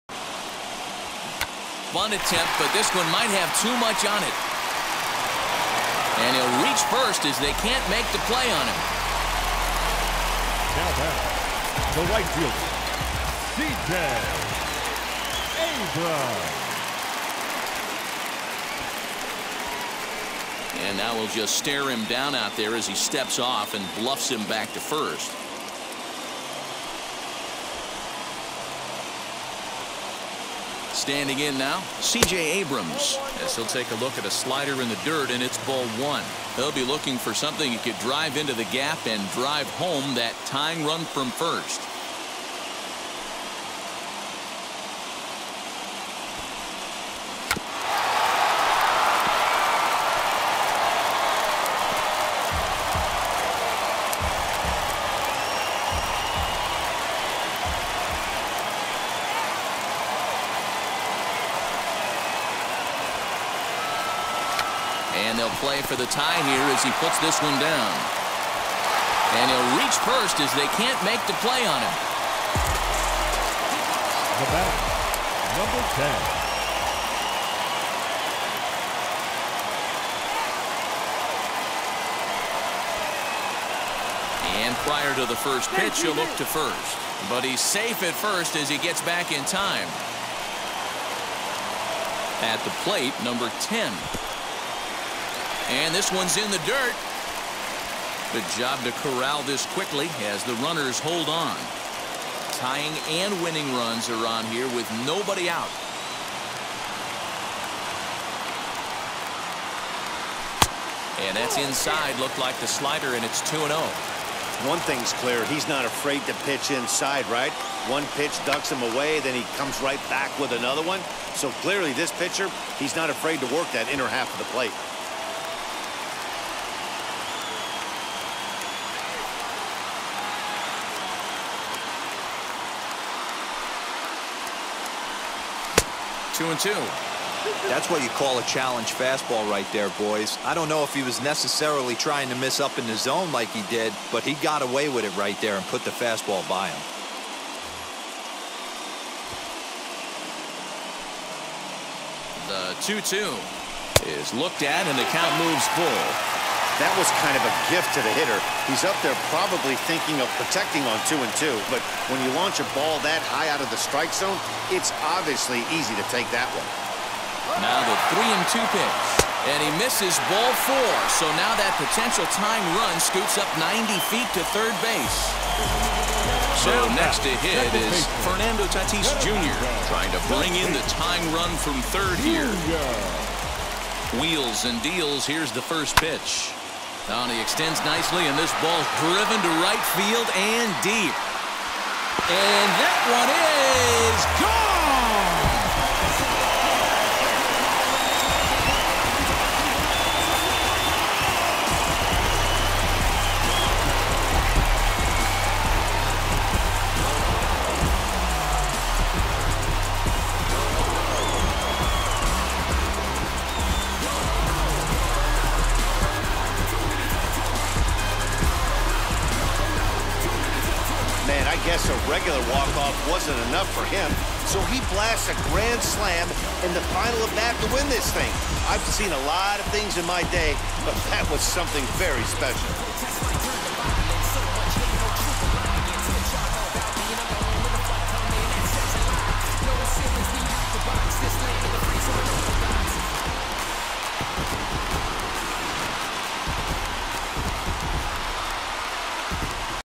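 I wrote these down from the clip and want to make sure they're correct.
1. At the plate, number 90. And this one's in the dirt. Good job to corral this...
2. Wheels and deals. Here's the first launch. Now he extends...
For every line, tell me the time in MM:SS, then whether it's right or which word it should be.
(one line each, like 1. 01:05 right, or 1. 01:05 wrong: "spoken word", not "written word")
1. 01:32 wrong: "10", not "90"
2. 03:04 wrong: "pitch", not "launch".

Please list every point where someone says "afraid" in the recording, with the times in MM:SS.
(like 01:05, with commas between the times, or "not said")
01:55, 02:03.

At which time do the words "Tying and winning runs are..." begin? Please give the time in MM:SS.
01:42.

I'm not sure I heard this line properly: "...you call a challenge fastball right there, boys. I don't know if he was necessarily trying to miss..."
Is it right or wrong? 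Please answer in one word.
right.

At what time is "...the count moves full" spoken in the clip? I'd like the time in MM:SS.
02:34.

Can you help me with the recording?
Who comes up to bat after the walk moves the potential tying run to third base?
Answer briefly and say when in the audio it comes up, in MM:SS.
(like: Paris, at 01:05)
Fernando Tatis Jr., at 02:58.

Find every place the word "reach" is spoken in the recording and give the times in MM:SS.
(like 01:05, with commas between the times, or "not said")
00:06, 01:09.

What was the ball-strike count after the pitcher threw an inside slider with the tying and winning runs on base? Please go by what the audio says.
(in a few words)
2-0.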